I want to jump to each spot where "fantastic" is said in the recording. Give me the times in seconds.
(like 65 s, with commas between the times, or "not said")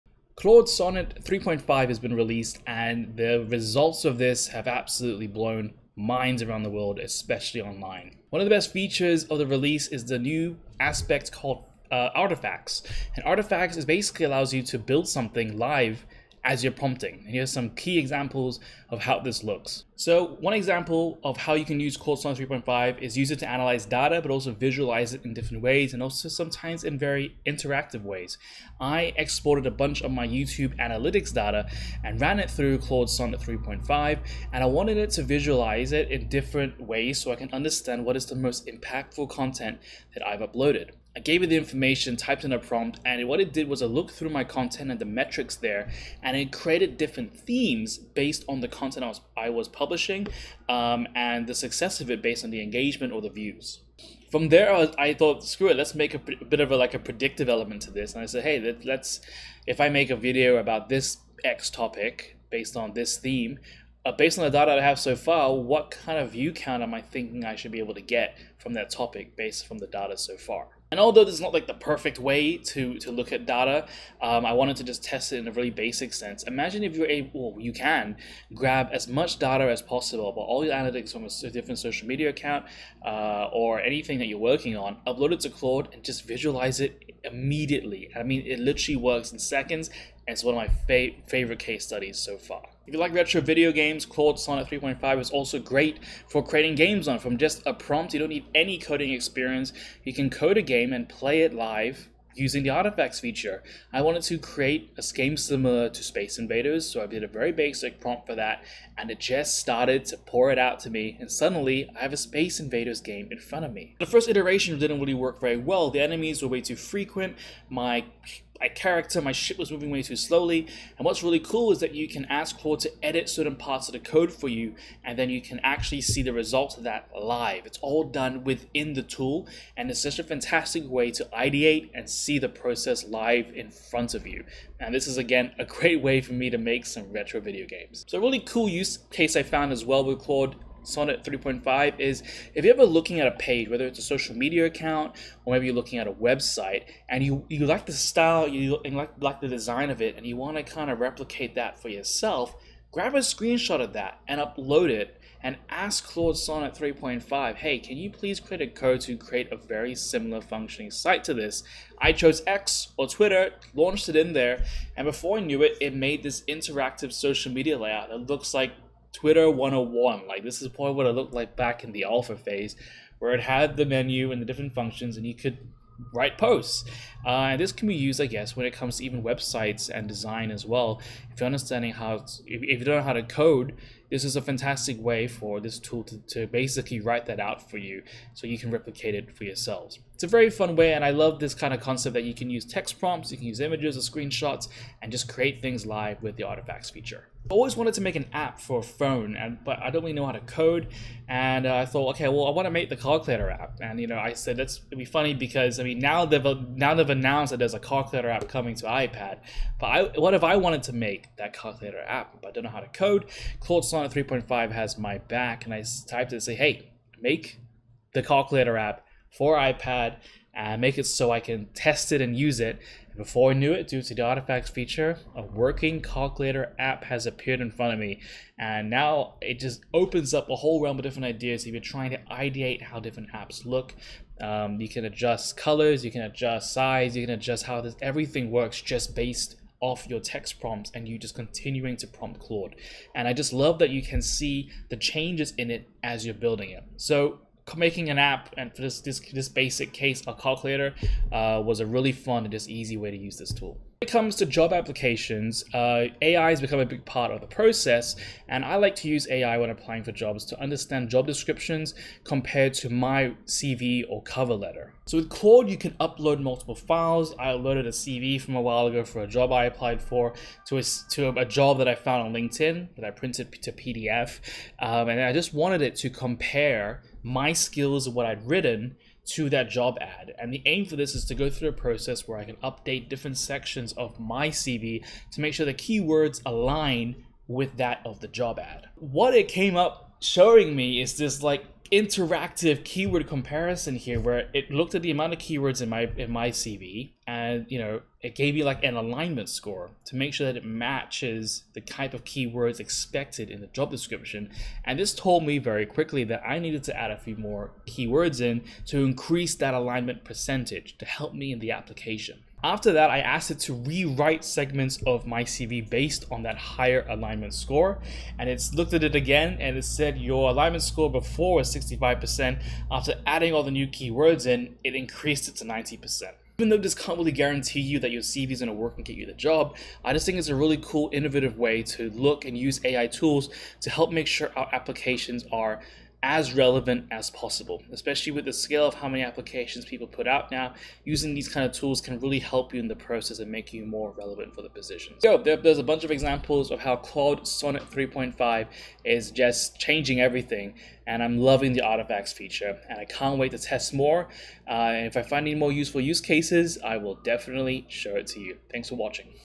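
130 s, 184 s.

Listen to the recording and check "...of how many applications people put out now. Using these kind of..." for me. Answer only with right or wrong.
right.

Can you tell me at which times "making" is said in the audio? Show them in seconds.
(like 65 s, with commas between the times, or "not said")
247 s.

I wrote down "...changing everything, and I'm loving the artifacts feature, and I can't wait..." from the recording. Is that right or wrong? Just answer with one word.
right.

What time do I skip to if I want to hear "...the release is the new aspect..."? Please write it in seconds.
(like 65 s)
9 s.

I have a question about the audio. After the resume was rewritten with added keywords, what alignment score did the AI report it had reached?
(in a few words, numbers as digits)
90%.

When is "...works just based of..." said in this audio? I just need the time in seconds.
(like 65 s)
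238 s.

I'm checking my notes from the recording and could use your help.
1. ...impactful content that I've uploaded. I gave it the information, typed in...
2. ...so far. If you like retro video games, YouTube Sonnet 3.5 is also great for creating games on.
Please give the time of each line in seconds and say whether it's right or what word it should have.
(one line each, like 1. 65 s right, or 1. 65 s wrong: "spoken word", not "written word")
1. 38 s right
2. 92 s wrong: "Claude", not "YouTube".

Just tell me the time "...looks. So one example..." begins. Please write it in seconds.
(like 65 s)
19 s.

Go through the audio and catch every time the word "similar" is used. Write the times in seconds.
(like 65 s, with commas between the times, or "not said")
105 s, 159 s.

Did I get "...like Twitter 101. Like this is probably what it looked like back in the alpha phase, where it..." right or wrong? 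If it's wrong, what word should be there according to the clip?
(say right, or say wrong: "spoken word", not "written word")
right.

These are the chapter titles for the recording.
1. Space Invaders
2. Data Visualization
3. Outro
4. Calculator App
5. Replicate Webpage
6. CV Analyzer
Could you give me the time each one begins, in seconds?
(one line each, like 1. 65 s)
1. 94 s
2. 21 s
3. 345 s
4. 198 s
5. 138 s
6. 254 s.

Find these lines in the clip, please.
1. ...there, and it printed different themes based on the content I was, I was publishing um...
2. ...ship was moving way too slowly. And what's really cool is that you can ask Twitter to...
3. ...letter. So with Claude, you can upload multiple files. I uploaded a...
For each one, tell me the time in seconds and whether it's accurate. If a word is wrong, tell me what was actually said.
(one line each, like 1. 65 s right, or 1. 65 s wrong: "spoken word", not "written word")
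1. 45 s wrong: "created", not "printed"
2. 119 s wrong: "Claude", not "Twitter"
3. 264 s right.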